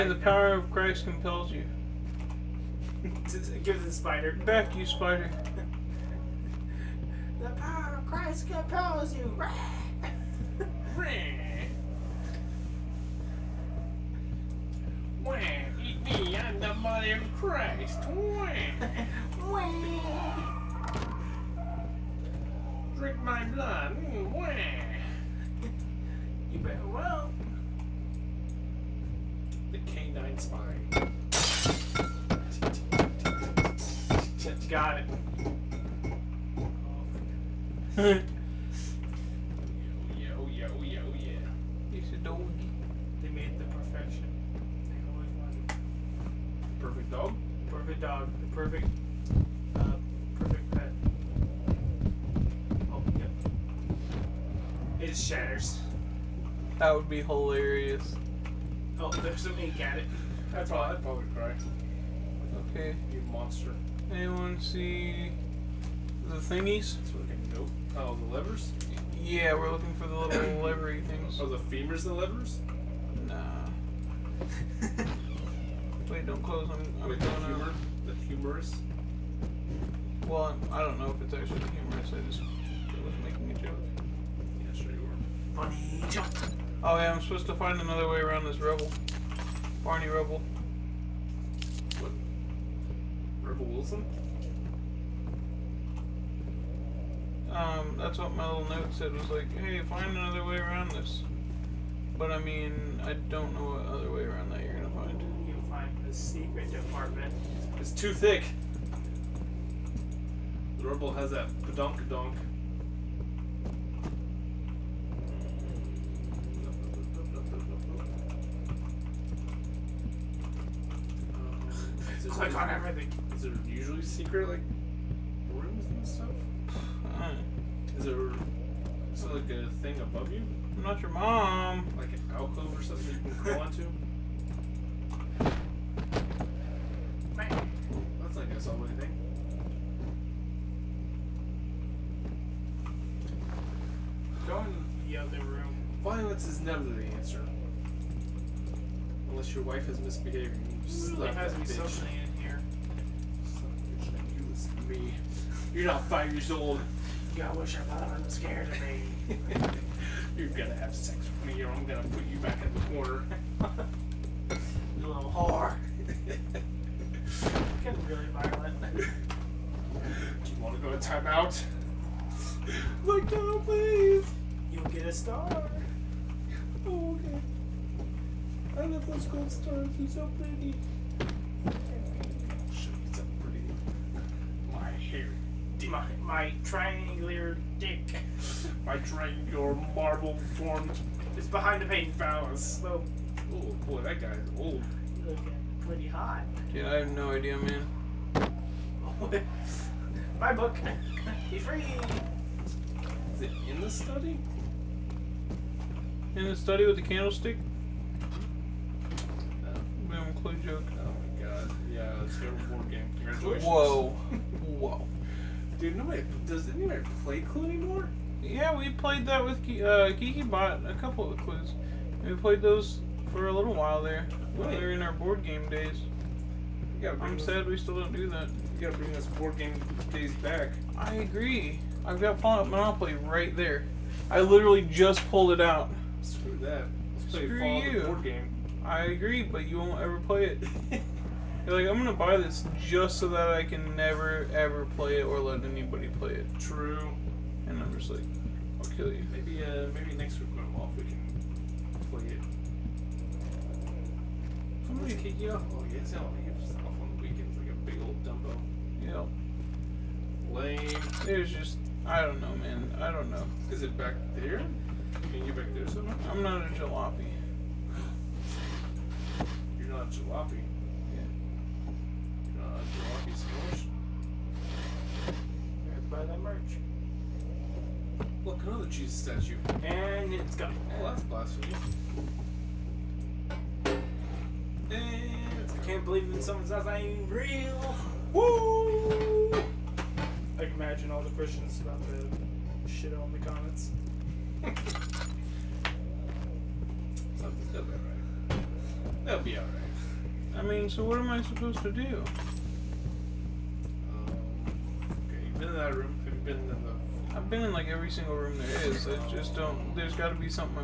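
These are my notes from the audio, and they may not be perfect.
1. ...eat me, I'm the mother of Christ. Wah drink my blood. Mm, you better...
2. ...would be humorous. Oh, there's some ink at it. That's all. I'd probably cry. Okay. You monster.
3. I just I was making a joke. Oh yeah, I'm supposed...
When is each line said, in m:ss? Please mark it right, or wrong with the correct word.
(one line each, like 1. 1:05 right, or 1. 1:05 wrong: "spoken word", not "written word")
1. 0:15 right
2. 0:56 wrong: "hilarious", not "humorous"
3. 1:22 right.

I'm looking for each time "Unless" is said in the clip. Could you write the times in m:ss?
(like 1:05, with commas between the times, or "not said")
2:29.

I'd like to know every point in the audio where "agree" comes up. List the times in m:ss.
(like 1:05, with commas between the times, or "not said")
3:51, 3:59.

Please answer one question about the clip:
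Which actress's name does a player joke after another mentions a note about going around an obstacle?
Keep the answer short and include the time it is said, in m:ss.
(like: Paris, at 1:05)
Rebel Wilson, at 1:33.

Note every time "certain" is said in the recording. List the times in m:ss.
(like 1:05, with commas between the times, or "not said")
not said.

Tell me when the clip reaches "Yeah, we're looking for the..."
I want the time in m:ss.
1:09.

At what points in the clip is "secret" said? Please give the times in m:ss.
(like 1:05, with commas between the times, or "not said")
1:46, 2:04.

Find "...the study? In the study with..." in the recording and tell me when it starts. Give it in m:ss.
3:23.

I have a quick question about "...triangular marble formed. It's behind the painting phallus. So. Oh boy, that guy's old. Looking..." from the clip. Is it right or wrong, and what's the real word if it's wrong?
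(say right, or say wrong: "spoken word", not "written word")
right.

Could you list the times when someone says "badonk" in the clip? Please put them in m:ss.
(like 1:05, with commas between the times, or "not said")
1:51.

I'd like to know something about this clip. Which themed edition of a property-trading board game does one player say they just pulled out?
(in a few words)
Fallout Monopoly.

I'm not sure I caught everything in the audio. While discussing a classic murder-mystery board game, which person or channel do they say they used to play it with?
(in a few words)
GeekyBot.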